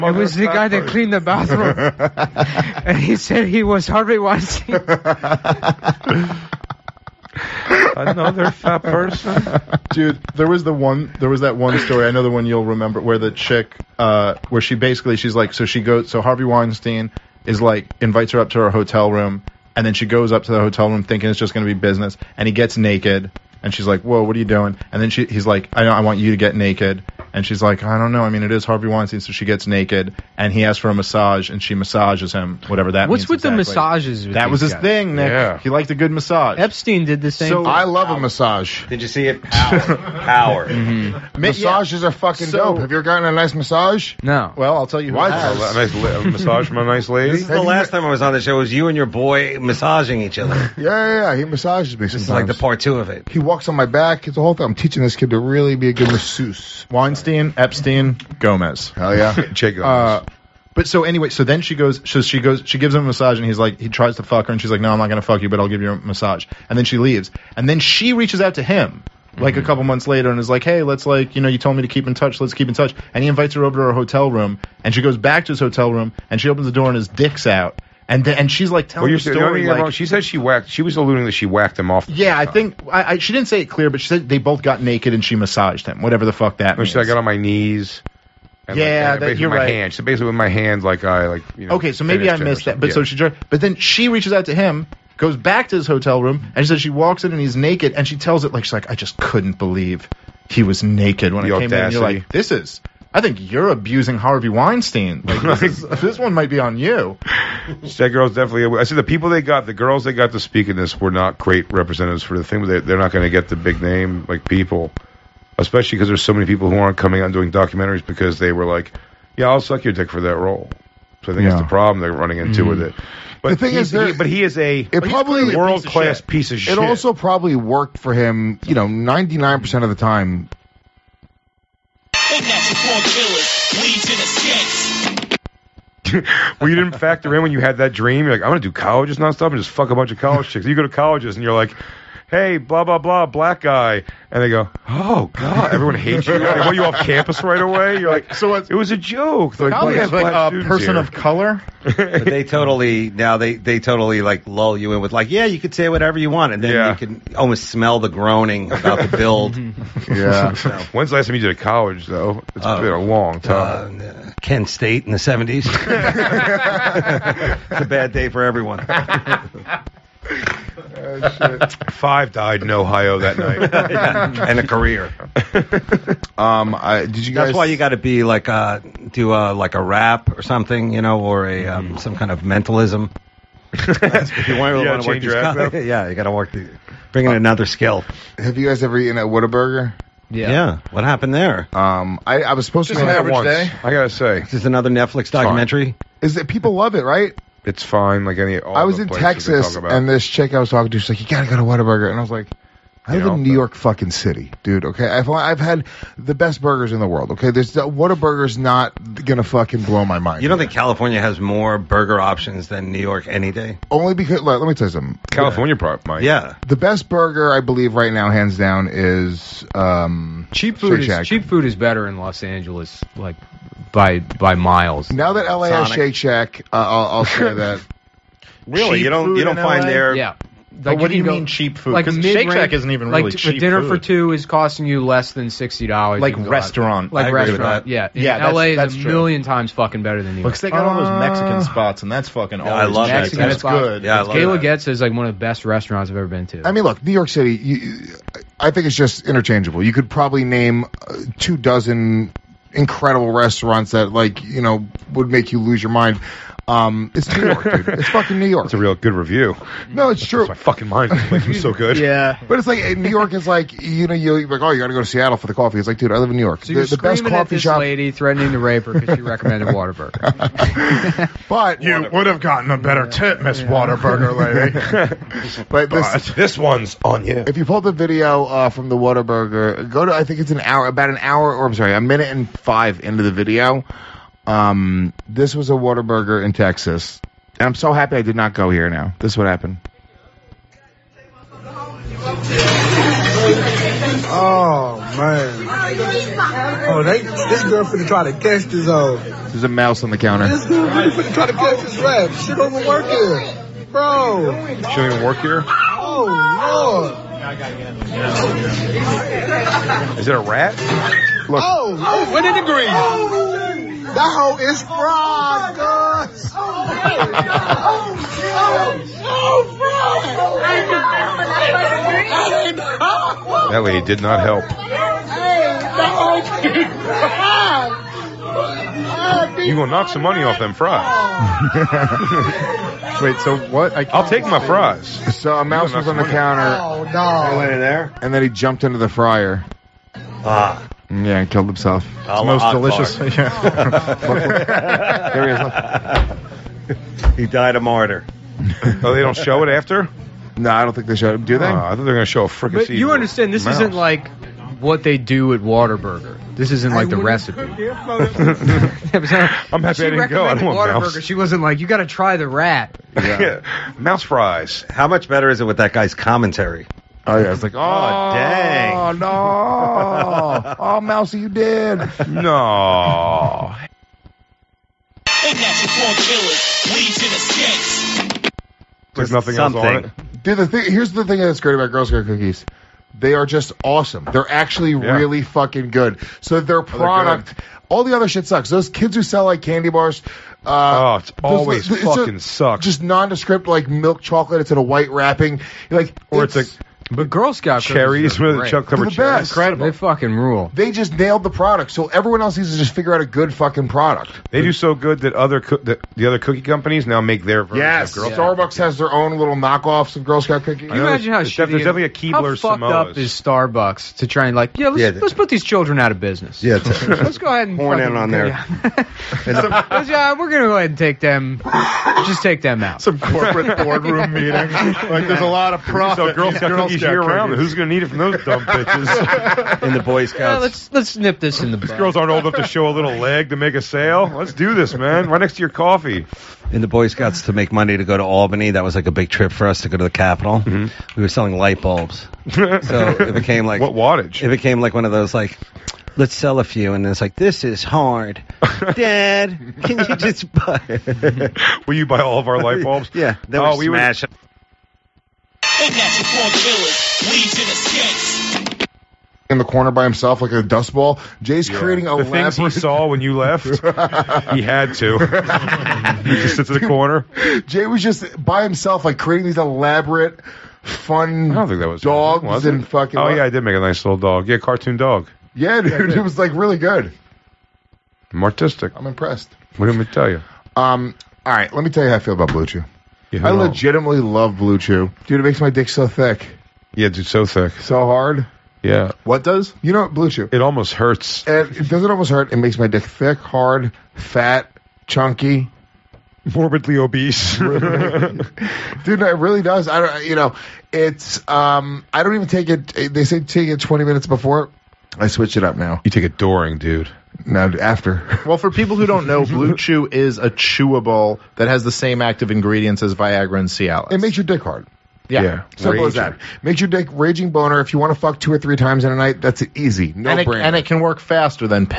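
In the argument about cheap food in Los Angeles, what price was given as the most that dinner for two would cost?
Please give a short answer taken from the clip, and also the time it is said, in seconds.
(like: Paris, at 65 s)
$60, at 235 s.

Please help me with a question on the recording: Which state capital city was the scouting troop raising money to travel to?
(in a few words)
Albany.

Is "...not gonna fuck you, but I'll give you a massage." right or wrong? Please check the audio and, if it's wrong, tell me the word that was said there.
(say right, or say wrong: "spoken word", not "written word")
right.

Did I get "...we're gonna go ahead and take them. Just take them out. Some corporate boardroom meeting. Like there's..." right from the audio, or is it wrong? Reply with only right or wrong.
right.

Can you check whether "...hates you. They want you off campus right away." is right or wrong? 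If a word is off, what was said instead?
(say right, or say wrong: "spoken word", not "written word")
right.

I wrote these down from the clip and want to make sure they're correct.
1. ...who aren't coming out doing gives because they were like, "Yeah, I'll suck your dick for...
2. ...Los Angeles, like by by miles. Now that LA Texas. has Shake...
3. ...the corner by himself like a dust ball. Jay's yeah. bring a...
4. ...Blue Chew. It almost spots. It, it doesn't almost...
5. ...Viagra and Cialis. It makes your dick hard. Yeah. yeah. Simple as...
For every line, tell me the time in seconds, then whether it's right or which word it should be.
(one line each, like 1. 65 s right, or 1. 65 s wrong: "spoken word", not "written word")
1. 116 s wrong: "documentaries", not "gives"
2. 222 s wrong: "Sonic", not "Texas"
3. 459 s wrong: "creating", not "bring"
4. 490 s wrong: "hurts", not "spots"
5. 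513 s right.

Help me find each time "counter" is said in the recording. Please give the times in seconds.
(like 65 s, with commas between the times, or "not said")
300 s, 336 s.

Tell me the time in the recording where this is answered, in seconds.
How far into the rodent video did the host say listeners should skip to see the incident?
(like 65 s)
281 s.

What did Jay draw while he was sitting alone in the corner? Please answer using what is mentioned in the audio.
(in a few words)
Cartoon dog.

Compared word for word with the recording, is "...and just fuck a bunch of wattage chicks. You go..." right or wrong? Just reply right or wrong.
wrong.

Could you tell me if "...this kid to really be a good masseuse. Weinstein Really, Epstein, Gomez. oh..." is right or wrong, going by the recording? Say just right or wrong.
wrong.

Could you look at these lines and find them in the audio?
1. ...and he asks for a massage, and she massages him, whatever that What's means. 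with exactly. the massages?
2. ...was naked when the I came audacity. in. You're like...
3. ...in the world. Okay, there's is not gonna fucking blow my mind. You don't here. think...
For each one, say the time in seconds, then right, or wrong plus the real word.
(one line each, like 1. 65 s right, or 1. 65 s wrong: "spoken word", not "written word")
1. 30 s right
2. 100 s right
3. 206 s right.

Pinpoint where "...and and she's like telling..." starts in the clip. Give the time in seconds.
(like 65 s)
78 s.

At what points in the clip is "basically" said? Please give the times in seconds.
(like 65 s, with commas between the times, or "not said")
14 s, 90 s.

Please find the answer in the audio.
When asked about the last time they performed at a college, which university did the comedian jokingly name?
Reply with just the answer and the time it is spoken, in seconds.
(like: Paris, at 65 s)
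Kent State, at 164 s.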